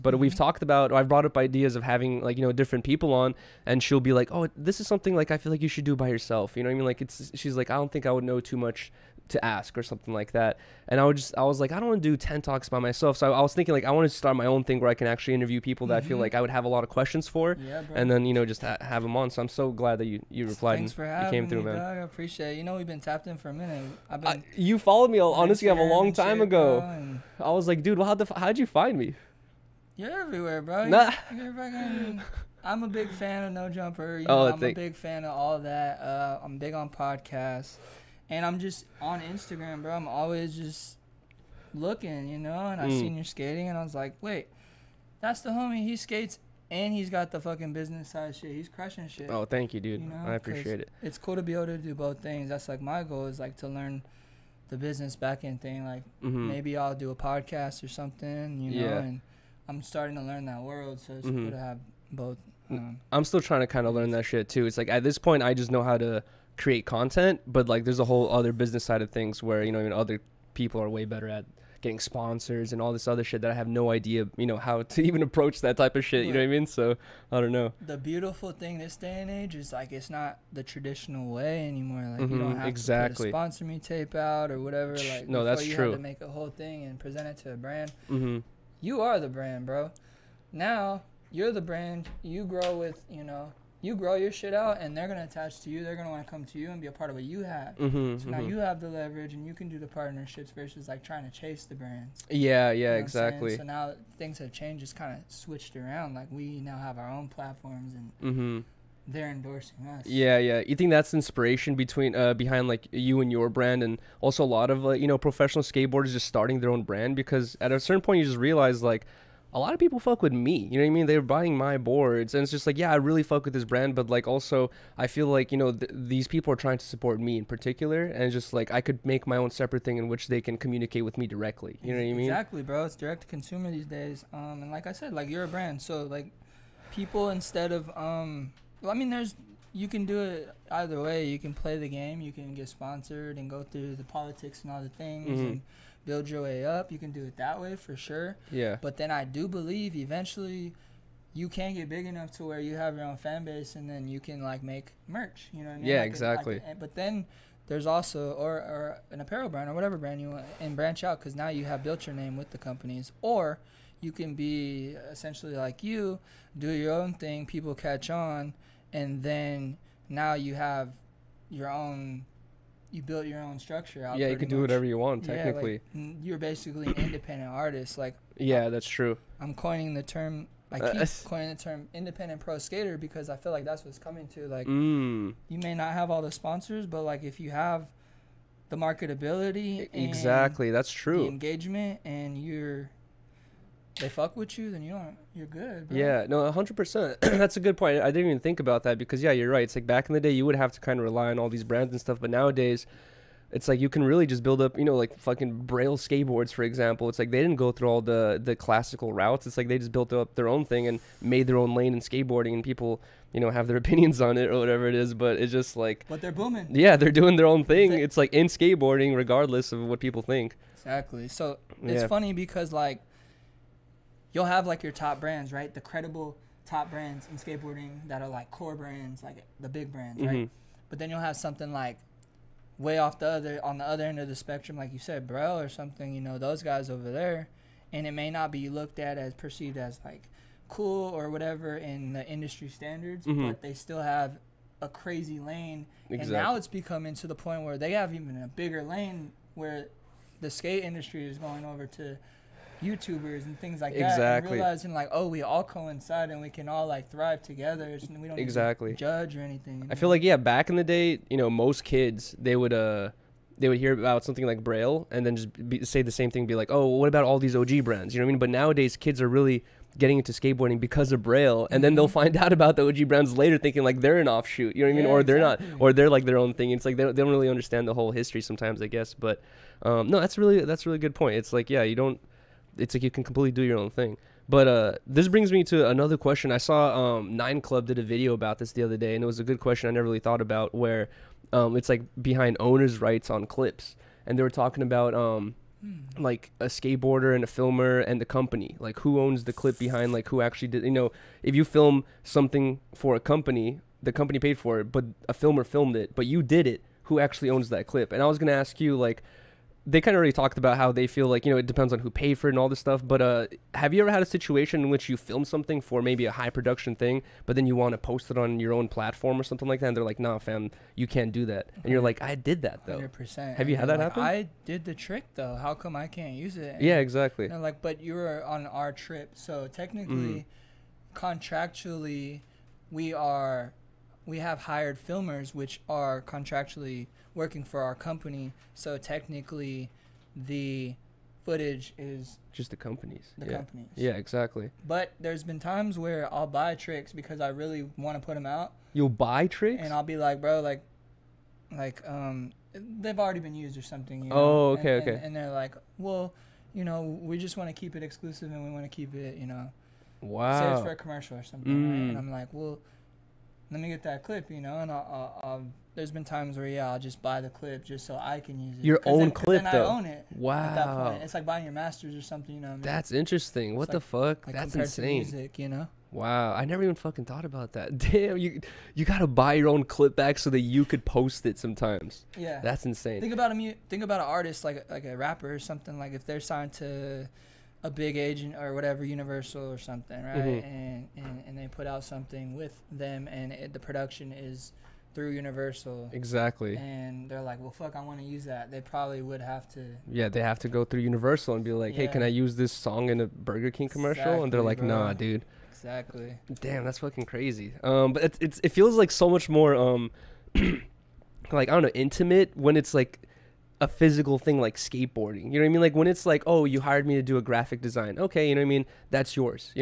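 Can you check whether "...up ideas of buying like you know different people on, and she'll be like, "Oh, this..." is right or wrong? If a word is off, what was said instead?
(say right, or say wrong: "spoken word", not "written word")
wrong: "having", not "buying".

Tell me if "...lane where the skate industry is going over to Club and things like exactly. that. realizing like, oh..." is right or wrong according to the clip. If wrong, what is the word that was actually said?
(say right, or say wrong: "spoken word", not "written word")
wrong: "YouTubers", not "Club".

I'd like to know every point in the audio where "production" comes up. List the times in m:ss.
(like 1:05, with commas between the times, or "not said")
5:16, 6:33.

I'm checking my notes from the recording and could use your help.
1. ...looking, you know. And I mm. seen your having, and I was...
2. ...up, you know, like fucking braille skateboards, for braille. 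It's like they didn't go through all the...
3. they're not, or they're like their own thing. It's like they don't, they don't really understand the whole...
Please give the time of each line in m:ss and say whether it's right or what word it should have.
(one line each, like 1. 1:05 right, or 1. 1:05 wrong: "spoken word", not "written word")
1. 0:41 wrong: "skating", not "having"
2. 3:24 wrong: "example", not "braille"
3. 4:35 right.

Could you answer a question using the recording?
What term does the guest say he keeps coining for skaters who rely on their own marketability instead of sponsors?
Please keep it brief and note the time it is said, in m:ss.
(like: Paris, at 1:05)
independent pro skater, at 3:01.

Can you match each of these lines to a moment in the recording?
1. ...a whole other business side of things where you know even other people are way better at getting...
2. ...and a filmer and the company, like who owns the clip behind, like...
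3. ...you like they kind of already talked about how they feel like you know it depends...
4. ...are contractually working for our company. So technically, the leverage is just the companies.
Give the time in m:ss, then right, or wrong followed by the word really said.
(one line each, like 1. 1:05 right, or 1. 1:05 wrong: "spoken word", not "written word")
1. 1:07 right
2. 4:57 right
3. 5:08 right
4. 5:35 wrong: "footage", not "leverage".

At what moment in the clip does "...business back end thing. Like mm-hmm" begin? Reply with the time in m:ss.
0:54.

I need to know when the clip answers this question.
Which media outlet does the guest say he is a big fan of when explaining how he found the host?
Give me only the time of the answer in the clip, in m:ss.
0:33.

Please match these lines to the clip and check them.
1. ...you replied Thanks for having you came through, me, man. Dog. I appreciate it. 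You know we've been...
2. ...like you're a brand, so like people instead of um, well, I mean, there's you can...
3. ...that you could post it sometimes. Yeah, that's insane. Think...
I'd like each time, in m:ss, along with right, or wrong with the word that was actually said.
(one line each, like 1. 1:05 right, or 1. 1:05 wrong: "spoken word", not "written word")
1. 0:20 right
2. 2:15 right
3. 6:20 right.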